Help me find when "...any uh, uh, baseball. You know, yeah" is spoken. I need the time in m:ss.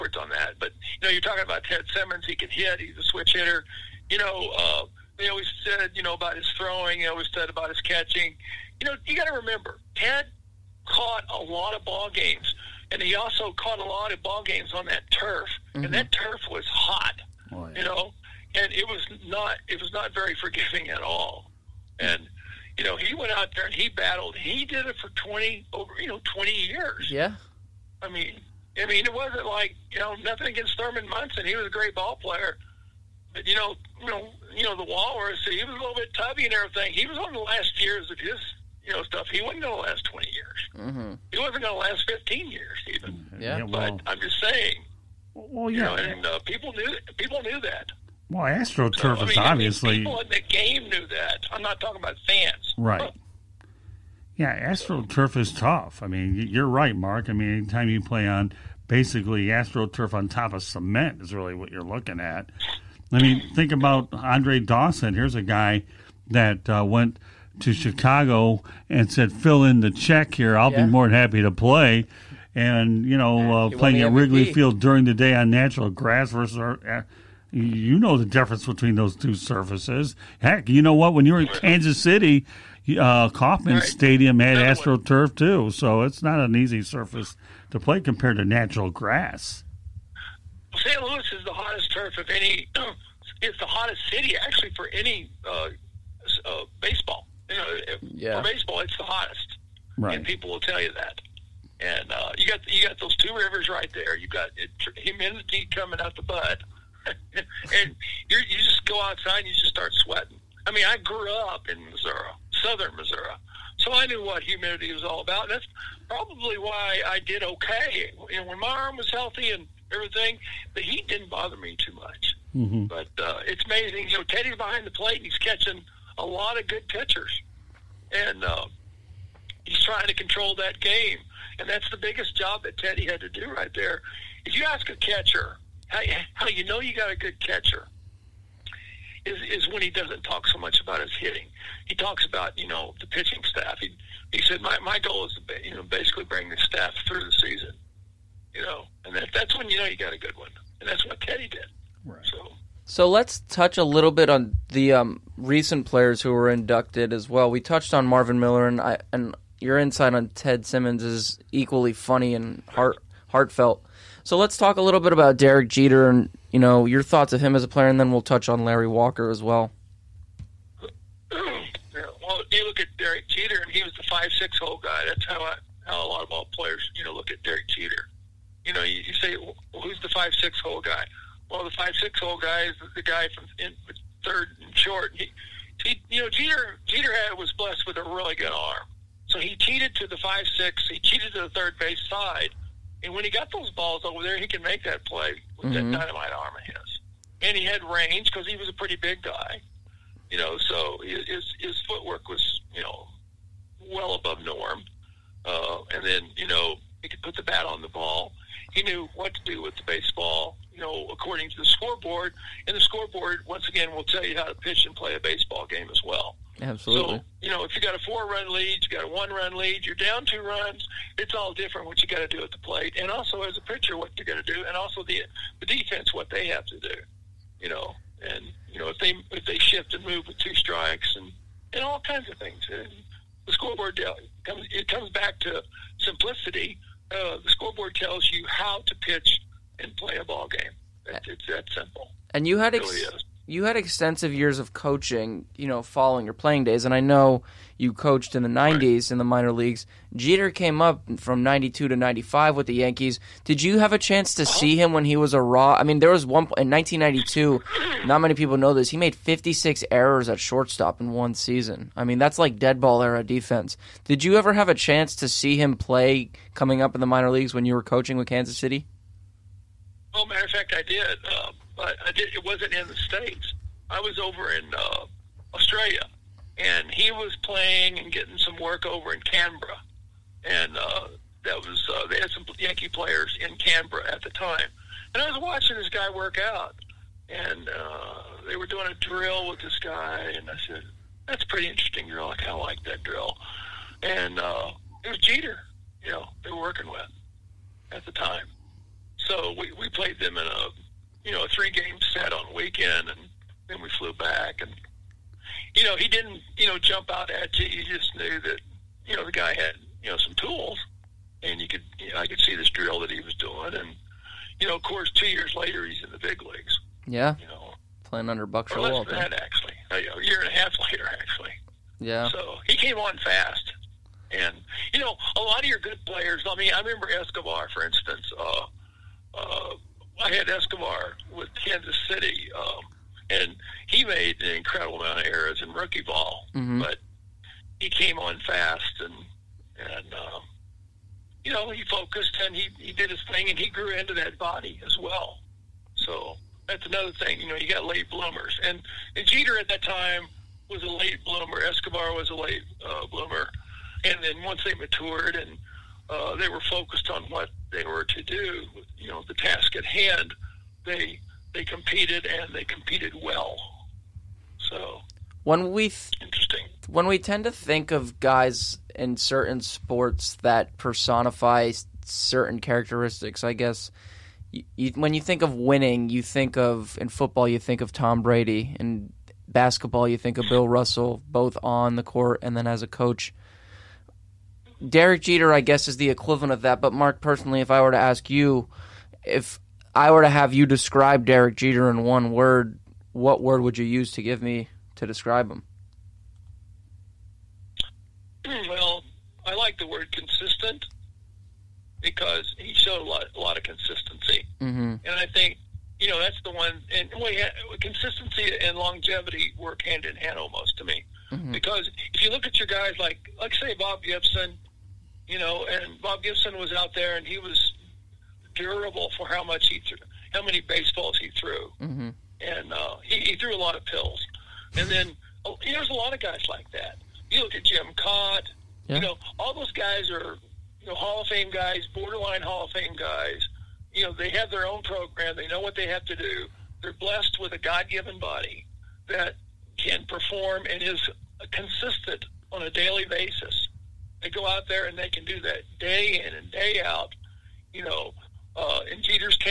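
1:34.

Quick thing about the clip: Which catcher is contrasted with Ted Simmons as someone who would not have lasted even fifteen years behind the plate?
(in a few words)
Thurman Munson.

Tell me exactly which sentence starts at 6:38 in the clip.
Well, I like the word consistent because he showed a lot, a lot of consistency, mm-hmm.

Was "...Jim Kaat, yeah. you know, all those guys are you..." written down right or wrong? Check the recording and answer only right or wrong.
right.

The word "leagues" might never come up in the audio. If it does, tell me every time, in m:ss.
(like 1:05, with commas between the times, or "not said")
4:09, 4:27, 5:16.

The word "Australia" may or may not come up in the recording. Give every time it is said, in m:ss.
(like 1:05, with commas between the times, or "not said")
4:35.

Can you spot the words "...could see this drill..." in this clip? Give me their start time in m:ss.
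5:12.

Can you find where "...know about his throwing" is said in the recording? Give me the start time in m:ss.
0:06.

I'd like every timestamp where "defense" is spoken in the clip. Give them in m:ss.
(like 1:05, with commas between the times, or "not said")
3:45, 4:23.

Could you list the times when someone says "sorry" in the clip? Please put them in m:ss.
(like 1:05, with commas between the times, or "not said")
not said.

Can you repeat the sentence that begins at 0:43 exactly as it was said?
Yeah, yeah well, but I'm just saying.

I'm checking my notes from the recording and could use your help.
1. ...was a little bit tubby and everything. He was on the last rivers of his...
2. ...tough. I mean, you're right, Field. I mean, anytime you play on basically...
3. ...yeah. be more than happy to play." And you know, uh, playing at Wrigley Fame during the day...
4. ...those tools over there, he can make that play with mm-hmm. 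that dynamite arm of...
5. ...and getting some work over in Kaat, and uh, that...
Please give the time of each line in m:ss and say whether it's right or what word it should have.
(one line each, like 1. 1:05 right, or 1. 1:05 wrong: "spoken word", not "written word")
1. 0:35 wrong: "years", not "rivers"
2. 0:55 wrong: "Mark", not "Field"
3. 1:10 wrong: "Field", not "Fame"
4. 3:13 wrong: "balls", not "tools"
5. 4:37 wrong: "Canberra", not "Kaat".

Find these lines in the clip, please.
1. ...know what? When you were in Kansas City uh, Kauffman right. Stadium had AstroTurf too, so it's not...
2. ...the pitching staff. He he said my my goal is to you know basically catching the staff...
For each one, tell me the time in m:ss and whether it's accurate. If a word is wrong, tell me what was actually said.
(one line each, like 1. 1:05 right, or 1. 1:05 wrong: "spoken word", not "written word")
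1. 1:20 right
2. 2:23 wrong: "bring", not "catching".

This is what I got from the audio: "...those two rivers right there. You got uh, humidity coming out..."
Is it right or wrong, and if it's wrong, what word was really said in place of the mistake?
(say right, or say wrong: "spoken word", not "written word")
right.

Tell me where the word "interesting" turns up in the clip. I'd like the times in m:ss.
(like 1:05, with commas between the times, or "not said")
4:51, 6:06.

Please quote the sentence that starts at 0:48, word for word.
Well, AstroTurf so, mean, is obviously people in the game knew that.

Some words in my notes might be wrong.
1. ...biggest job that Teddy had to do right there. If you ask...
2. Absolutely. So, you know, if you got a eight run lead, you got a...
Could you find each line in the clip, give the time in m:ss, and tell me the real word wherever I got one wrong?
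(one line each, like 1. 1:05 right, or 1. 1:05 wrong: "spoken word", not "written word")
1. 2:11 right
2. 3:36 wrong: "four", not "eight".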